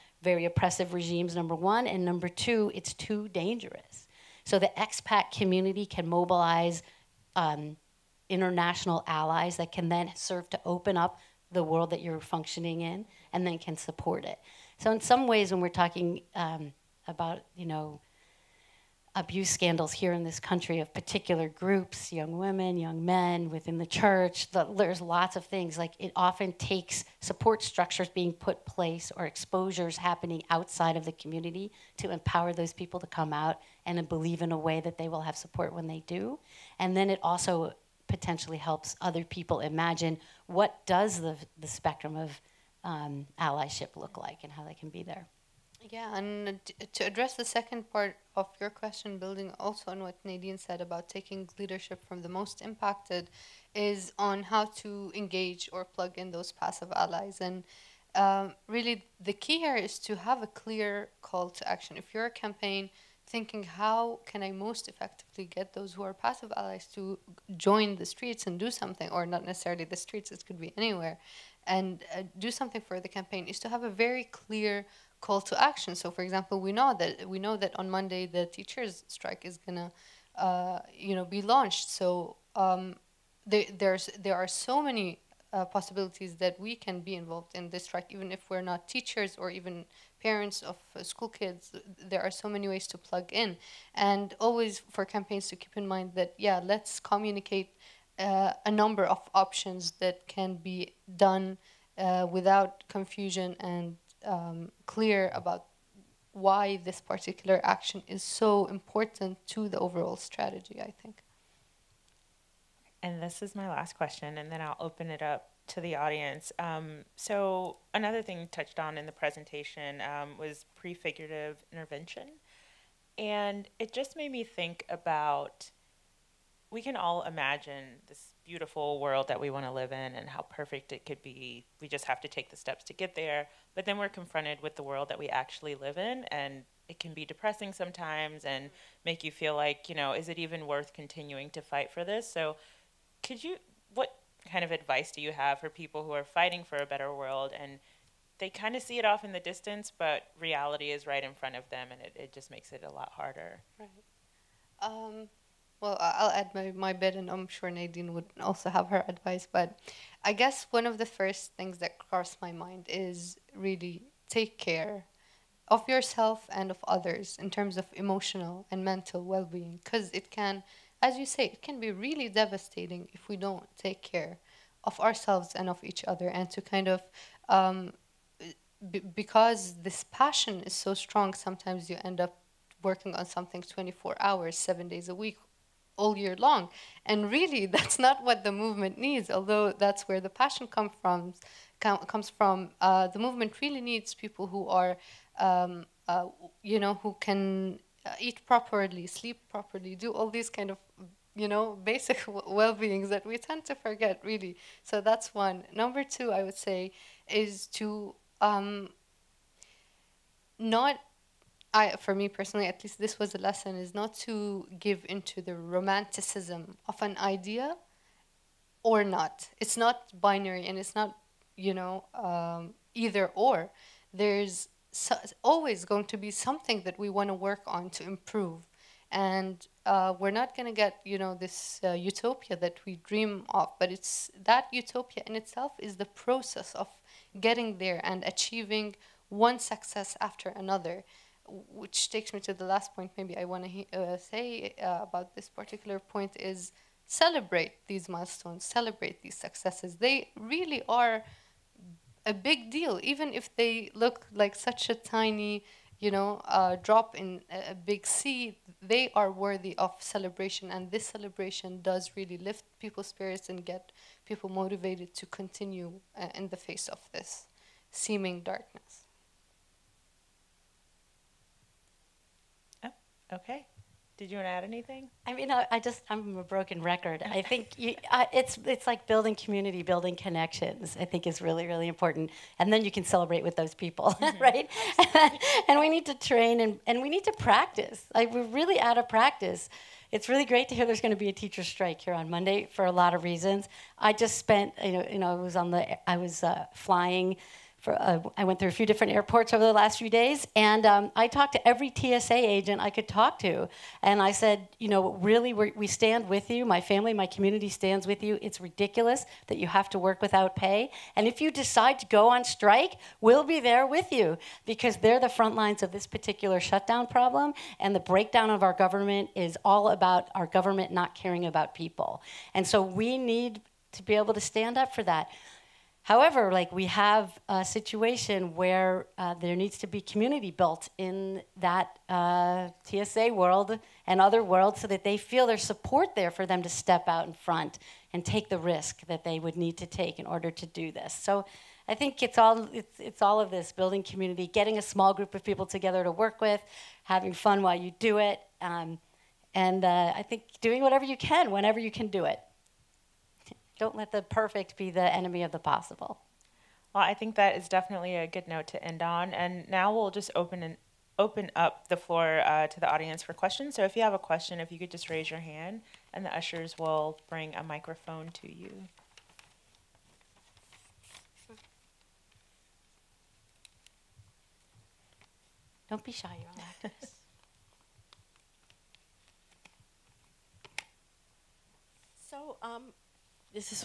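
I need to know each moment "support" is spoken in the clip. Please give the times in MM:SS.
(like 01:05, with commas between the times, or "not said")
00:13, 00:27, 00:35, 05:35.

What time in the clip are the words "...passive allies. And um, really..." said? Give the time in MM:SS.
00:56.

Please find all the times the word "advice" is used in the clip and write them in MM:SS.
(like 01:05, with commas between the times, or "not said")
02:24, 02:39.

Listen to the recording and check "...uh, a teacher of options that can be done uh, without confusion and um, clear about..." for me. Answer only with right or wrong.
wrong.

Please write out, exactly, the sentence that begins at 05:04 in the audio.
And I said, you know, really, we stand with you.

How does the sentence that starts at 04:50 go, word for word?
It's really great to hear there's going to be a teacher strike here on Monday for a lot of reasons.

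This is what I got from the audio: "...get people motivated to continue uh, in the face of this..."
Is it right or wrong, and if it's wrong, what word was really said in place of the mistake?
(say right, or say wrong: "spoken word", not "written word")
right.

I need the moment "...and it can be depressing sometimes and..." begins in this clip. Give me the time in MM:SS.
02:16.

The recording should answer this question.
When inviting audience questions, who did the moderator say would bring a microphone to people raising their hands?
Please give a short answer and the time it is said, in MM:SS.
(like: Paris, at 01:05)
the ushers, at 06:06.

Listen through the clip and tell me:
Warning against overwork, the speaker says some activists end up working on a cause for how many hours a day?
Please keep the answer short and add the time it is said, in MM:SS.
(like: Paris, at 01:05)
24, at 03:03.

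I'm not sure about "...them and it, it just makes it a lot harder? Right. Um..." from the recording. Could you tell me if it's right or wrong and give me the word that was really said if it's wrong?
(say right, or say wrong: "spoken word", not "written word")
right.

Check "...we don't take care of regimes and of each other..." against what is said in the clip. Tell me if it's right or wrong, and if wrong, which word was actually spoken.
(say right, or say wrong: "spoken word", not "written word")
wrong: "ourselves", not "regimes".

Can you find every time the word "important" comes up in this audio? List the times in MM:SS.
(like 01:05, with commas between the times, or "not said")
01:48, 04:41.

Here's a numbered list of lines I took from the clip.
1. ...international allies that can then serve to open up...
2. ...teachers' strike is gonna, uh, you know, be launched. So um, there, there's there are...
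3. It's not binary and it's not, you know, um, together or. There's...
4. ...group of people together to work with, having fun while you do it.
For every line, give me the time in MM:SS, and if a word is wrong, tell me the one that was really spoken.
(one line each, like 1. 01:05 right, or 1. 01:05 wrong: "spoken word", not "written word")
1. 00:08 right
2. 01:18 right
3. 03:39 wrong: "either", not "together"
4. 05:45 right.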